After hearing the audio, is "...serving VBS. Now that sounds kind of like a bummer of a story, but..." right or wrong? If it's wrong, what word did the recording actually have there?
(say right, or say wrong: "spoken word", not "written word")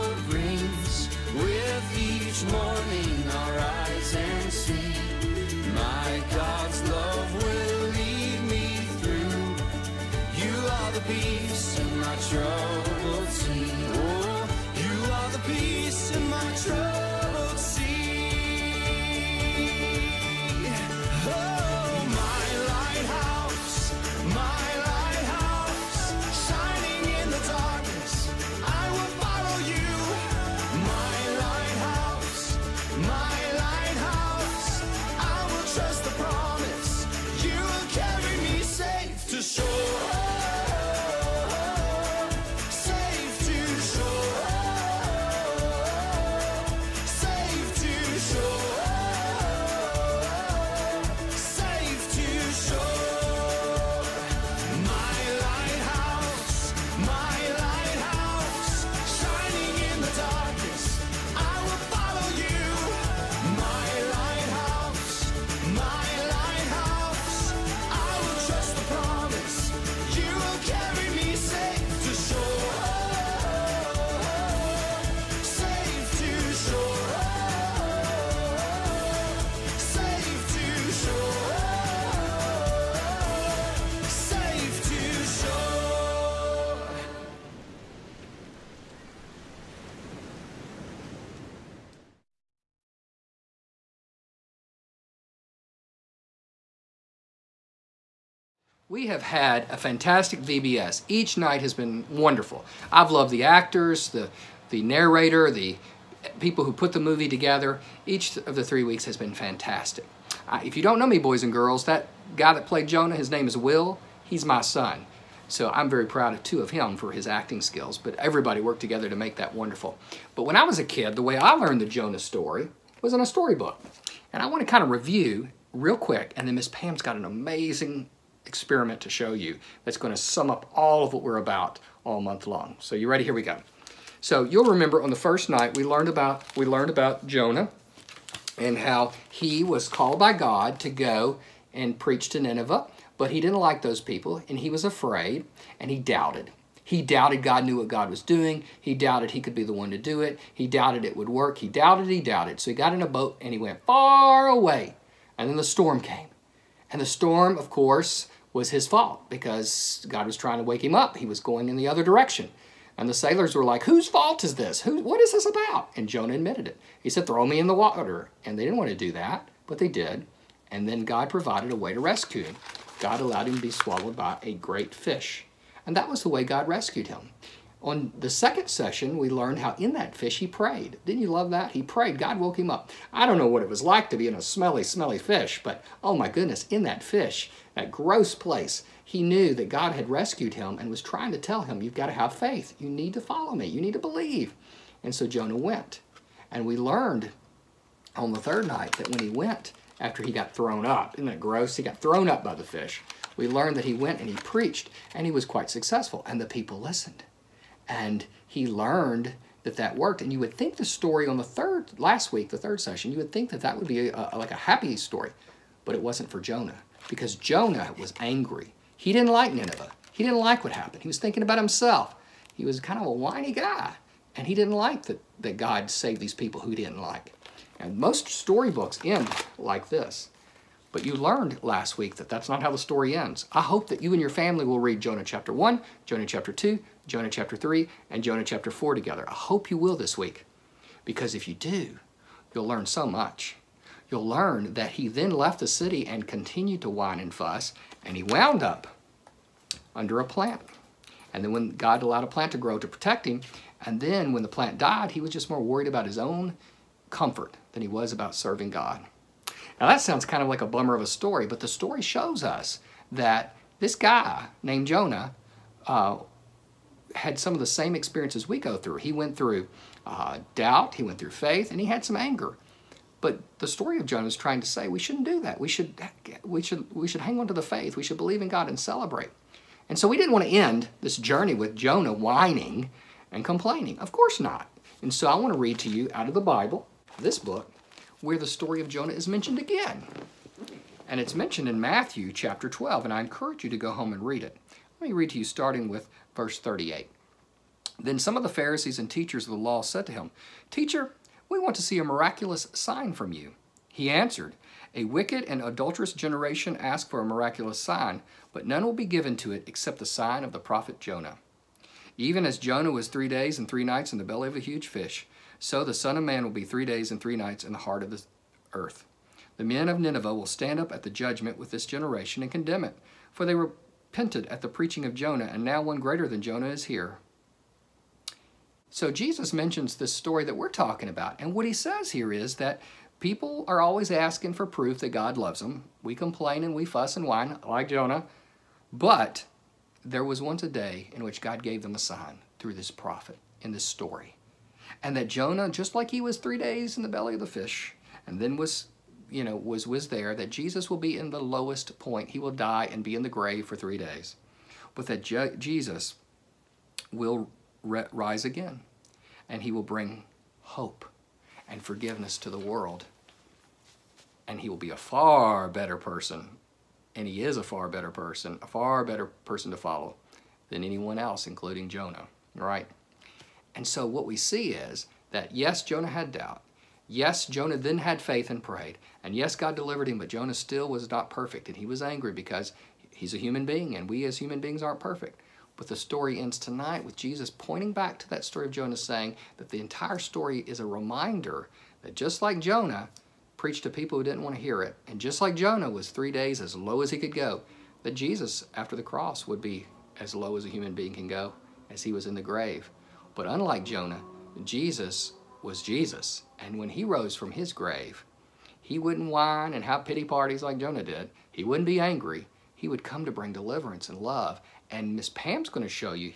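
wrong: "God", not "VBS".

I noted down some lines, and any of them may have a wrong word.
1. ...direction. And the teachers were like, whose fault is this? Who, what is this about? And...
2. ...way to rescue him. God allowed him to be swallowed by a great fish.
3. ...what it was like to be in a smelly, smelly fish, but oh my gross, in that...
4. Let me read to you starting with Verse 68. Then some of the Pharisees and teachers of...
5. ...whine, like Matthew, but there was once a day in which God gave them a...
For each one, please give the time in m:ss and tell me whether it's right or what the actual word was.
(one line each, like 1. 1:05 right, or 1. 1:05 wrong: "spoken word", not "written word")
1. 2:42 wrong: "sailors", not "teachers"
2. 2:51 right
3. 3:03 wrong: "goodness", not "gross"
4. 4:54 wrong: "38", not "68"
5. 5:37 wrong: "Jonah", not "Matthew".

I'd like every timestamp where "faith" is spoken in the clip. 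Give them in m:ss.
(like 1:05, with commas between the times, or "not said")
3:12, 4:31, 4:37, 6:18.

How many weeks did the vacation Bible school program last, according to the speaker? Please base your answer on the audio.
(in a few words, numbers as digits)
3.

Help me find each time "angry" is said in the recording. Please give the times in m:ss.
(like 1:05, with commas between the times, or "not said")
3:38, 6:22, 6:52.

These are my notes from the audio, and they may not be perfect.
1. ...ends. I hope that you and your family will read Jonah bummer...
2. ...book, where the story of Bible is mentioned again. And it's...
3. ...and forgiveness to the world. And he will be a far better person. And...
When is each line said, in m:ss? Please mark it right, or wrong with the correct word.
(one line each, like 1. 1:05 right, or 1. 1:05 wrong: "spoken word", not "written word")
1. 3:53 wrong: "chapter", not "bummer"
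2. 4:47 wrong: "Jonah", not "Bible"
3. 6:01 right.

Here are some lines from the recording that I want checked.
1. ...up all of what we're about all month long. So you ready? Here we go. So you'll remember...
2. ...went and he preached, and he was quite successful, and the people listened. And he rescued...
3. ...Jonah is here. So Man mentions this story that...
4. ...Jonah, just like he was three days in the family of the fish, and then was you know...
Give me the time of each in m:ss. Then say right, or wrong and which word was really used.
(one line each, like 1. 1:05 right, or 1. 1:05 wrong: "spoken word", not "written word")
1. 2:10 right
2. 3:23 wrong: "learned", not "rescued"
3. 5:26 wrong: "Jesus", not "Man"
4. 5:45 wrong: "belly", not "family".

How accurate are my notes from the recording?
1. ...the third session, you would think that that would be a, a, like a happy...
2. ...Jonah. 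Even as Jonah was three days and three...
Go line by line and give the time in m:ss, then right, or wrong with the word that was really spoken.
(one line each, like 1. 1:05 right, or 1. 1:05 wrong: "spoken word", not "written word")
1. 3:32 right
2. 5:11 right.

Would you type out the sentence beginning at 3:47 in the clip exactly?
And most storybooks end like this.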